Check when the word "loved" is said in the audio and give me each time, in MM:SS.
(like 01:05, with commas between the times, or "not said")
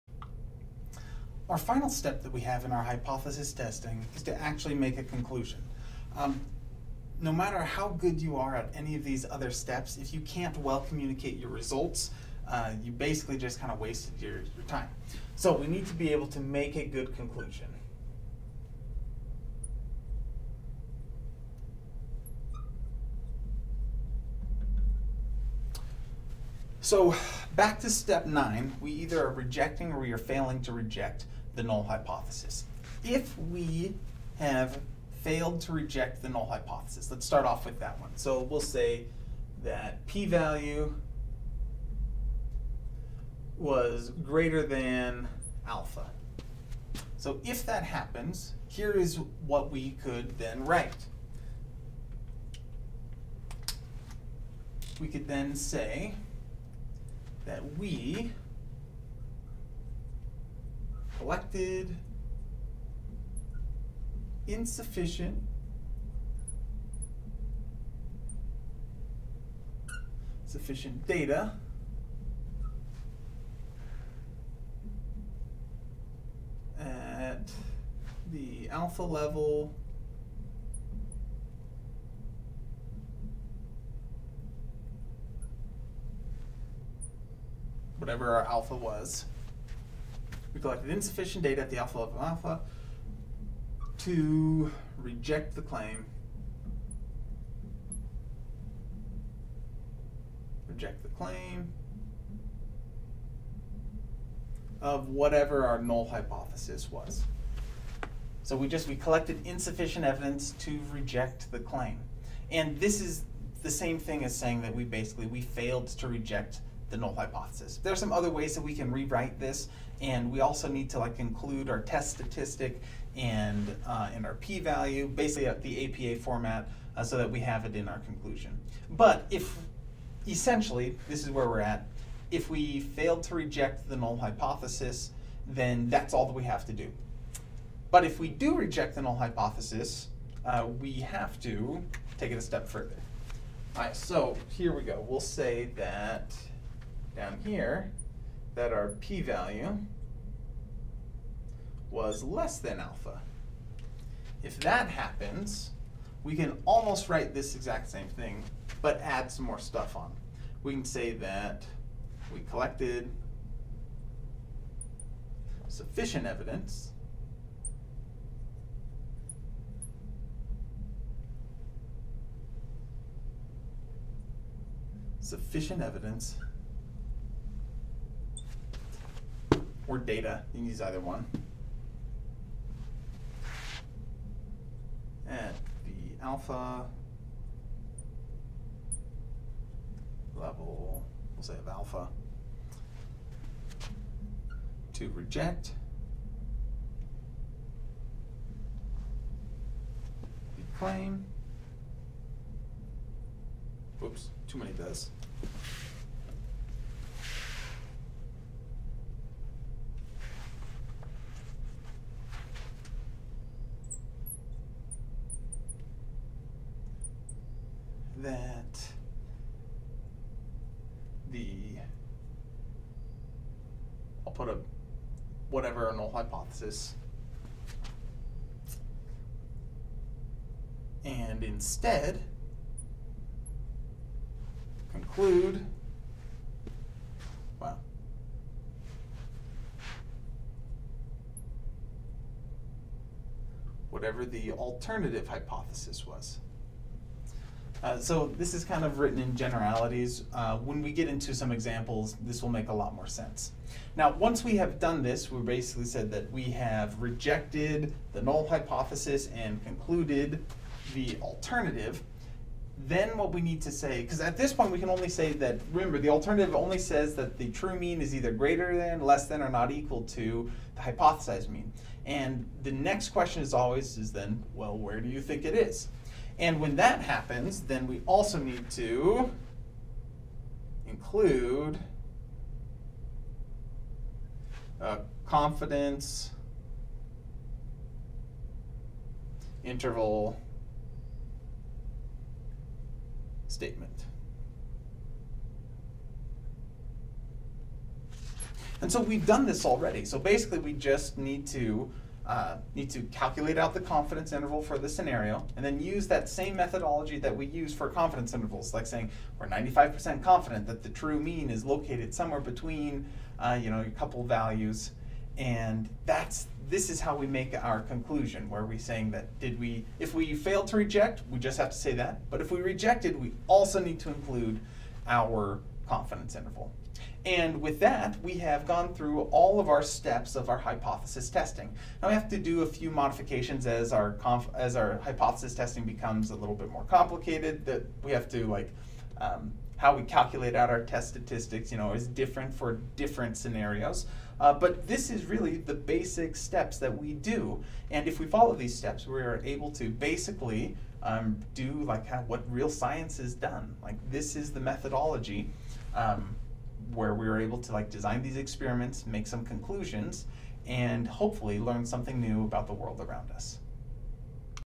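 not said.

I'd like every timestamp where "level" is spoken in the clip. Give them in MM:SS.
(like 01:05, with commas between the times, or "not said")
01:19, 01:31, 03:10.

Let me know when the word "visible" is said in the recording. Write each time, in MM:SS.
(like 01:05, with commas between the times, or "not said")
not said.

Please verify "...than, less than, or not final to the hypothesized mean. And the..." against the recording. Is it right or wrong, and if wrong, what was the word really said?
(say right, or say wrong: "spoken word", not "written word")
wrong: "equal", not "final".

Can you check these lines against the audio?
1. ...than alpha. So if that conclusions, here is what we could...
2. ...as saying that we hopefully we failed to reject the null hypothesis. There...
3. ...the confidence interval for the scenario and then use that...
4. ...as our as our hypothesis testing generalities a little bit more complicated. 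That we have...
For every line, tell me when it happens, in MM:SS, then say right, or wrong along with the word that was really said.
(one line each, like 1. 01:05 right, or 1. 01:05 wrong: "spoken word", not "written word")
1. 00:44 wrong: "happens", not "conclusions"
2. 01:54 wrong: "basically", not "hopefully"
3. 05:03 right
4. 05:33 wrong: "becomes", not "generalities".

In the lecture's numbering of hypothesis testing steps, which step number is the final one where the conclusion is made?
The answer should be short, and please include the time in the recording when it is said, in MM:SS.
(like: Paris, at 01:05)
9, at 00:28.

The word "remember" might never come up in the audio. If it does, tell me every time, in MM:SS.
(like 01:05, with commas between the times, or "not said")
04:25.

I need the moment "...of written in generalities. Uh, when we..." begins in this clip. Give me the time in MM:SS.
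04:08.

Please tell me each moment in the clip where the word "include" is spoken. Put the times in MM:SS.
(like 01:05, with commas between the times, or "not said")
02:01, 04:40, 05:24.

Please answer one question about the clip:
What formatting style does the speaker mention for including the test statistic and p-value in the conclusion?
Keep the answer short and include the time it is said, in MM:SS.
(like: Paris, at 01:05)
APA format, at 02:06.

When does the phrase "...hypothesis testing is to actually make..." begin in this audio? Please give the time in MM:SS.
00:02.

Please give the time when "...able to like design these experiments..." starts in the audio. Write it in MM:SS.
05:57.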